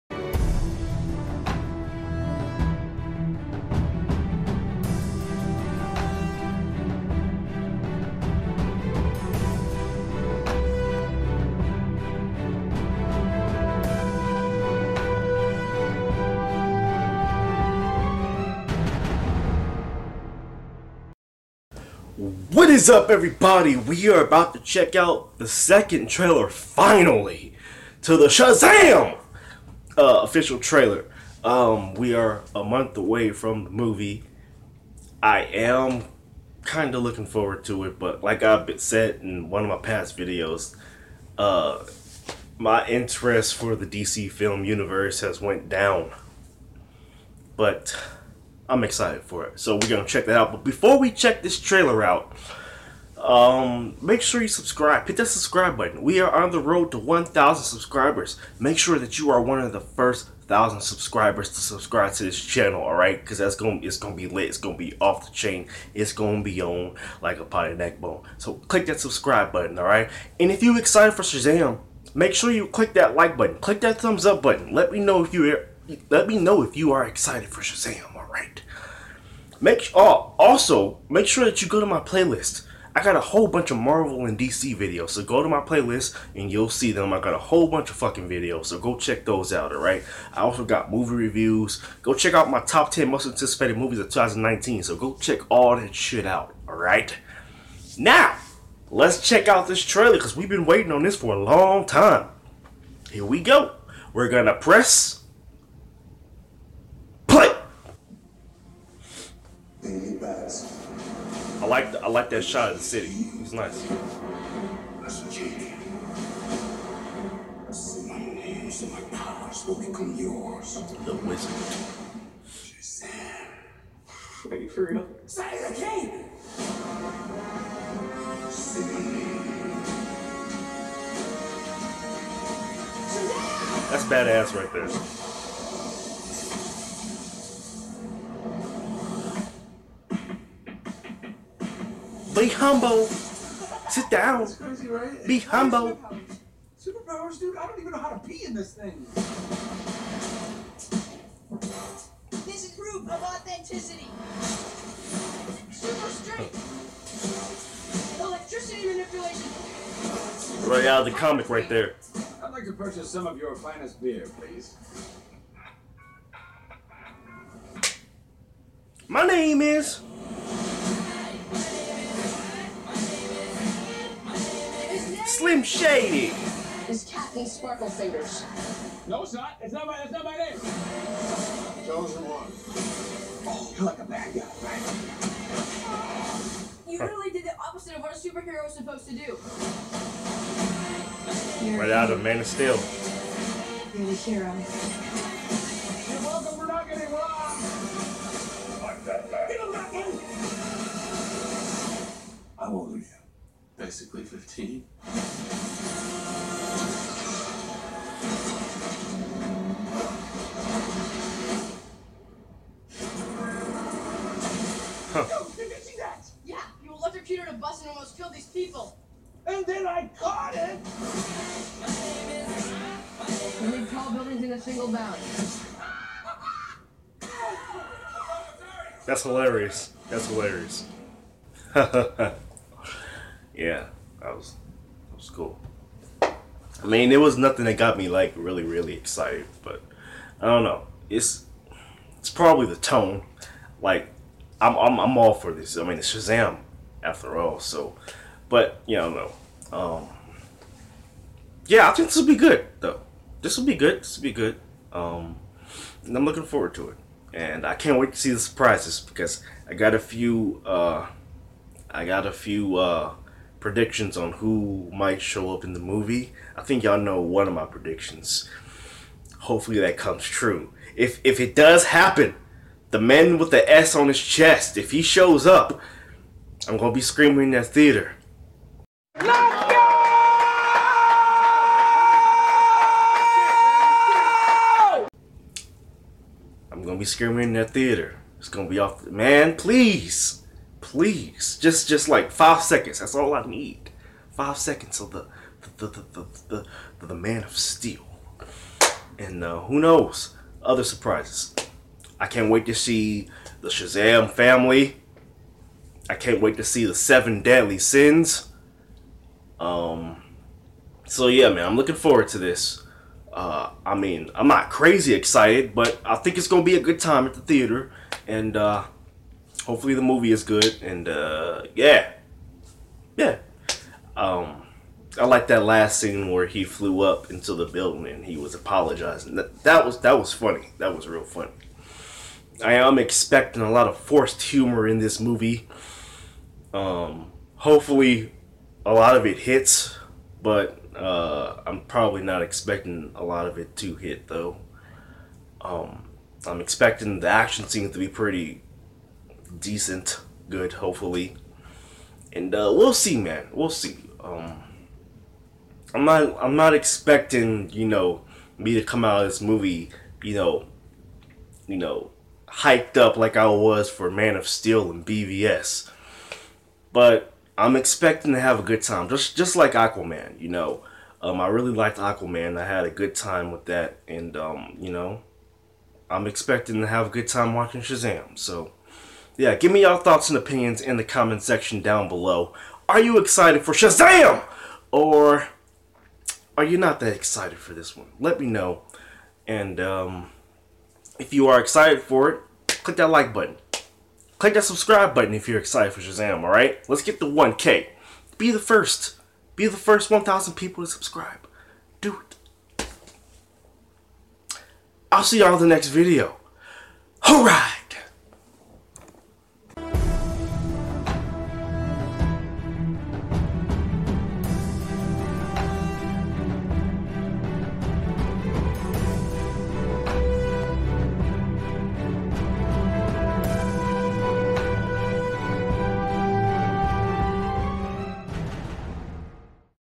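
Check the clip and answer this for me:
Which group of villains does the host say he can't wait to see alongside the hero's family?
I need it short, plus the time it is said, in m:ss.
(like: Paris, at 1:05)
The Seven Deadly Sins, at 5:06.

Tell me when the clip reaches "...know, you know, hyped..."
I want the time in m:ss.
6:00.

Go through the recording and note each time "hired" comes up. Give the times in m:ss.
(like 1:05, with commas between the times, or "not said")
not said.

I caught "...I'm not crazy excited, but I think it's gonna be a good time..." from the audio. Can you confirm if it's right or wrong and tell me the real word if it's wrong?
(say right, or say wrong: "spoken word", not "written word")
right.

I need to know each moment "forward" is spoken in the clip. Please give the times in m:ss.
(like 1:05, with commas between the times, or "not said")
0:37, 4:16, 5:11.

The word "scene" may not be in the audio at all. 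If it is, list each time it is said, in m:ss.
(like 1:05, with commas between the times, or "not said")
5:25, 5:47.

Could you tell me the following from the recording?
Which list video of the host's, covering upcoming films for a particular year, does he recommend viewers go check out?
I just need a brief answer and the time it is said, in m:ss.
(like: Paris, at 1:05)
Top 10 most anticipated movies of 2019, at 1:32.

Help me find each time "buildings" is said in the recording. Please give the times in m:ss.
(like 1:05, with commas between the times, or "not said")
3:44, 5:27.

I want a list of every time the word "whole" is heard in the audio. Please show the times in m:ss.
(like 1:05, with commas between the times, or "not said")
1:23, 1:27.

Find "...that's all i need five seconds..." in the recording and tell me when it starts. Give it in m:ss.
4:52.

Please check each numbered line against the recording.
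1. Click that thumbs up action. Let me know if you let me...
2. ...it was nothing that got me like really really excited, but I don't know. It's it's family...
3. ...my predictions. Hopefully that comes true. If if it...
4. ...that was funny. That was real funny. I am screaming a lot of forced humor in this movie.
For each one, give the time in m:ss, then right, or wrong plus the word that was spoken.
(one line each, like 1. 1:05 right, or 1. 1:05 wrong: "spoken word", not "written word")
1. 1:13 wrong: "button", not "action"
2. 3:57 wrong: "probably", not "family"
3. 4:27 right
4. 5:30 wrong: "expecting", not "screaming".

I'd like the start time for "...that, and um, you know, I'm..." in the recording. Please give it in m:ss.
6:13.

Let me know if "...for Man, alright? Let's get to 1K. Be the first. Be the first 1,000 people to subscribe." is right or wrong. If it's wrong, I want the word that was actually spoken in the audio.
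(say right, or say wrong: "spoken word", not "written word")
wrong: "Shazam", not "Man".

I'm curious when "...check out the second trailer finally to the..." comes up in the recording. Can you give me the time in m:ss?
0:24.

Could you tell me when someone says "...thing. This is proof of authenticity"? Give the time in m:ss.
2:28.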